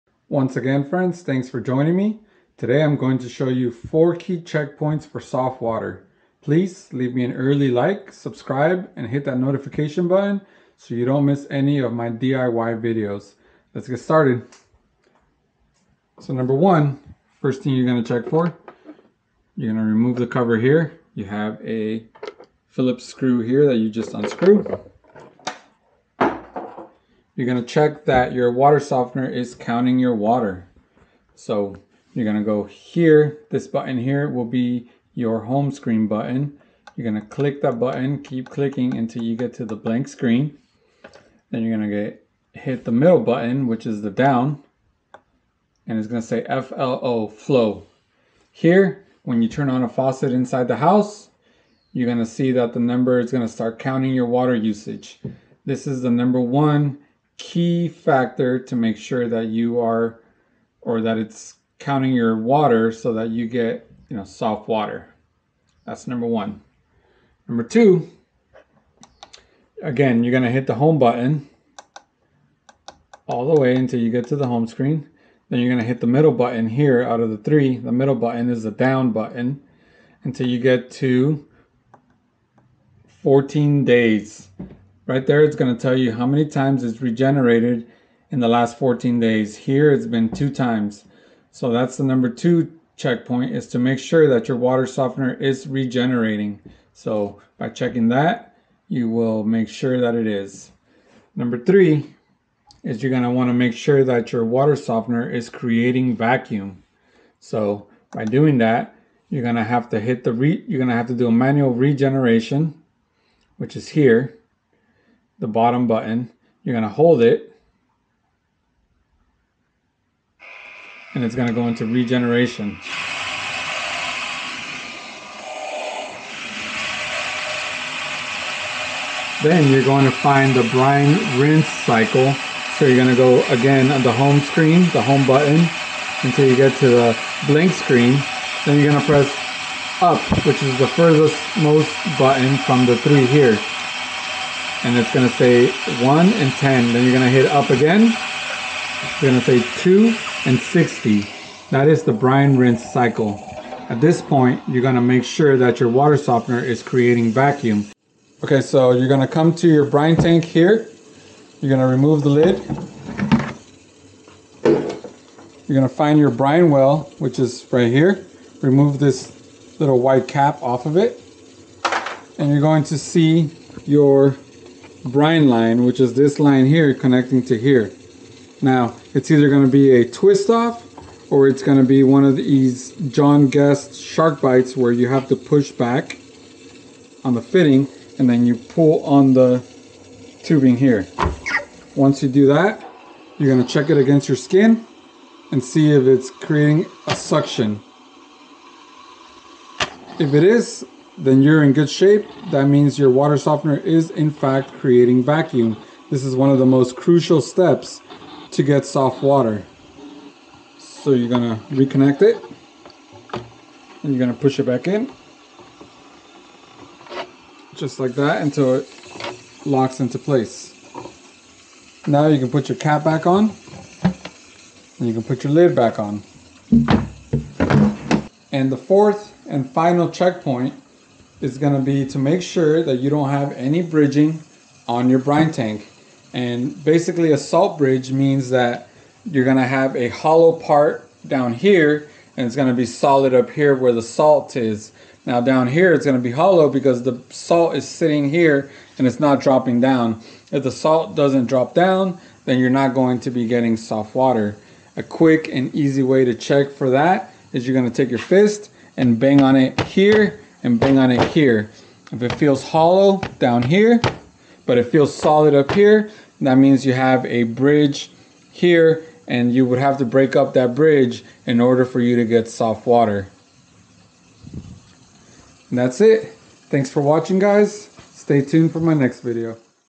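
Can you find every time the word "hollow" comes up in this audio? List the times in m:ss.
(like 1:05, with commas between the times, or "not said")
4:00, 4:06, 4:22.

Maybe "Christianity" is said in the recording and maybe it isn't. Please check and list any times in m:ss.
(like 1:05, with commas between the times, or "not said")
not said.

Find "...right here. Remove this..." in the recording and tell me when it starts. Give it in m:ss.
2:47.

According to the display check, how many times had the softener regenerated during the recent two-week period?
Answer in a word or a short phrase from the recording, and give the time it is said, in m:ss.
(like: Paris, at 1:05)
2, at 1:30.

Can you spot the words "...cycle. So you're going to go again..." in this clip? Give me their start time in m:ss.
2:11.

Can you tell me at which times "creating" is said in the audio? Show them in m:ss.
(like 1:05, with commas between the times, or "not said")
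1:45, 2:36, 3:16, 3:24.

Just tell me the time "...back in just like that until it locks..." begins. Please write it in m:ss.
3:34.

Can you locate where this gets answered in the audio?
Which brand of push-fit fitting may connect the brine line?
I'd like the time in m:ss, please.
3:03.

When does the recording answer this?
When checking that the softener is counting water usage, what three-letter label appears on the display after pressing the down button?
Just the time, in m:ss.
0:46.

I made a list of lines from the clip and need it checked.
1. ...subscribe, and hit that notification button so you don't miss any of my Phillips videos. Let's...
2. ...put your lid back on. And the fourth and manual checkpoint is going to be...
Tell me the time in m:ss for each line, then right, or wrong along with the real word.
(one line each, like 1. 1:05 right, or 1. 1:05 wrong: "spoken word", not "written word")
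1. 0:08 wrong: "DIY", not "Phillips"
2. 3:45 wrong: "final", not "manual".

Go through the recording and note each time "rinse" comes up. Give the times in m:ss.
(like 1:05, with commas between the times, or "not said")
2:11, 2:32.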